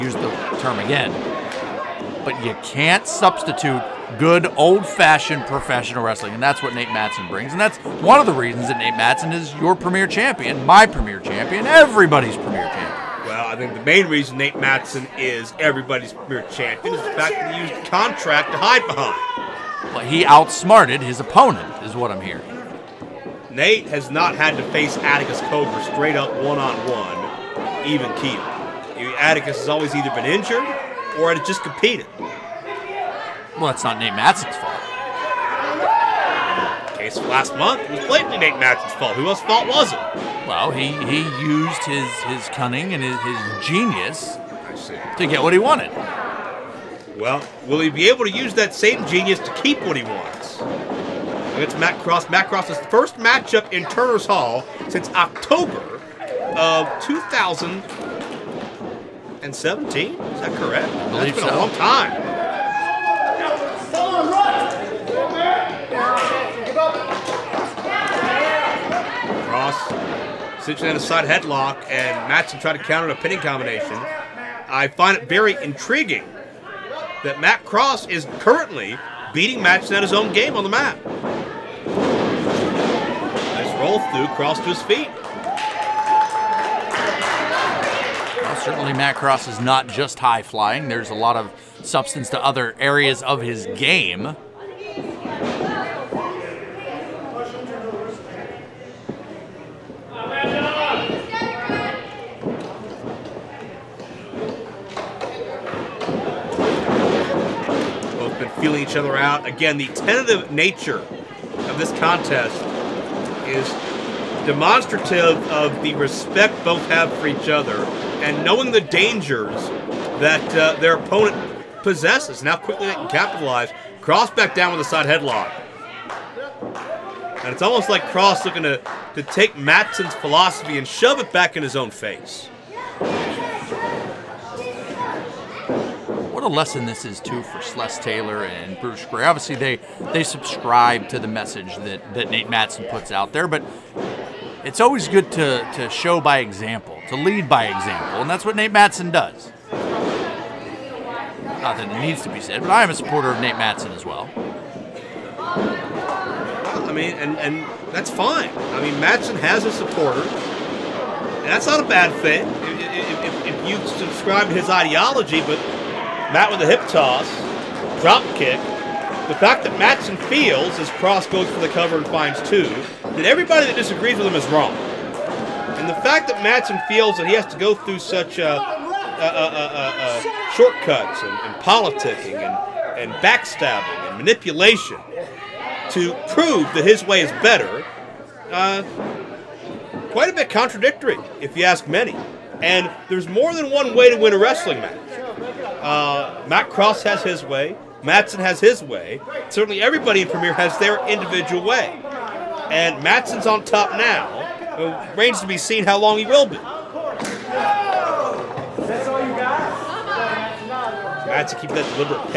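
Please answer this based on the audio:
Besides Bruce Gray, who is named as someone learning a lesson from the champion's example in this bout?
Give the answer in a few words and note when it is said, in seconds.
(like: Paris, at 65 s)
Sless Taylor, at 137 s.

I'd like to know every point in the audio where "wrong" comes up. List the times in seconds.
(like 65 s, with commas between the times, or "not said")
174 s.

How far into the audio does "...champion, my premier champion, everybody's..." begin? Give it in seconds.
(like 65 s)
10 s.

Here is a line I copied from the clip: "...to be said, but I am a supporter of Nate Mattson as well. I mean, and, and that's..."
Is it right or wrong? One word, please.
right.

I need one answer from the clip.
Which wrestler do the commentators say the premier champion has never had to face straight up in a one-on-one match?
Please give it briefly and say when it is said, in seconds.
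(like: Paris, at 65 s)
Atticus Cogar, at 24 s.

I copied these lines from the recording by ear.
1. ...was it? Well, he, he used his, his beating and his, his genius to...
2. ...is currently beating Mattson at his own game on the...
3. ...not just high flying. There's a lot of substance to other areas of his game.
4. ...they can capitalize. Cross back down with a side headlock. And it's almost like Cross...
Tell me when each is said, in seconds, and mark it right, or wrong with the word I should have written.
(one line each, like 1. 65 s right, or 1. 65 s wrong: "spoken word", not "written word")
1. 39 s wrong: "cunning", not "beating"
2. 78 s right
3. 89 s right
4. 122 s right.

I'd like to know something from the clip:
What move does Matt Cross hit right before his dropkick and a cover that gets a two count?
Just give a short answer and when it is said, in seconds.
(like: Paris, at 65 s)
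Hip toss, at 166 s.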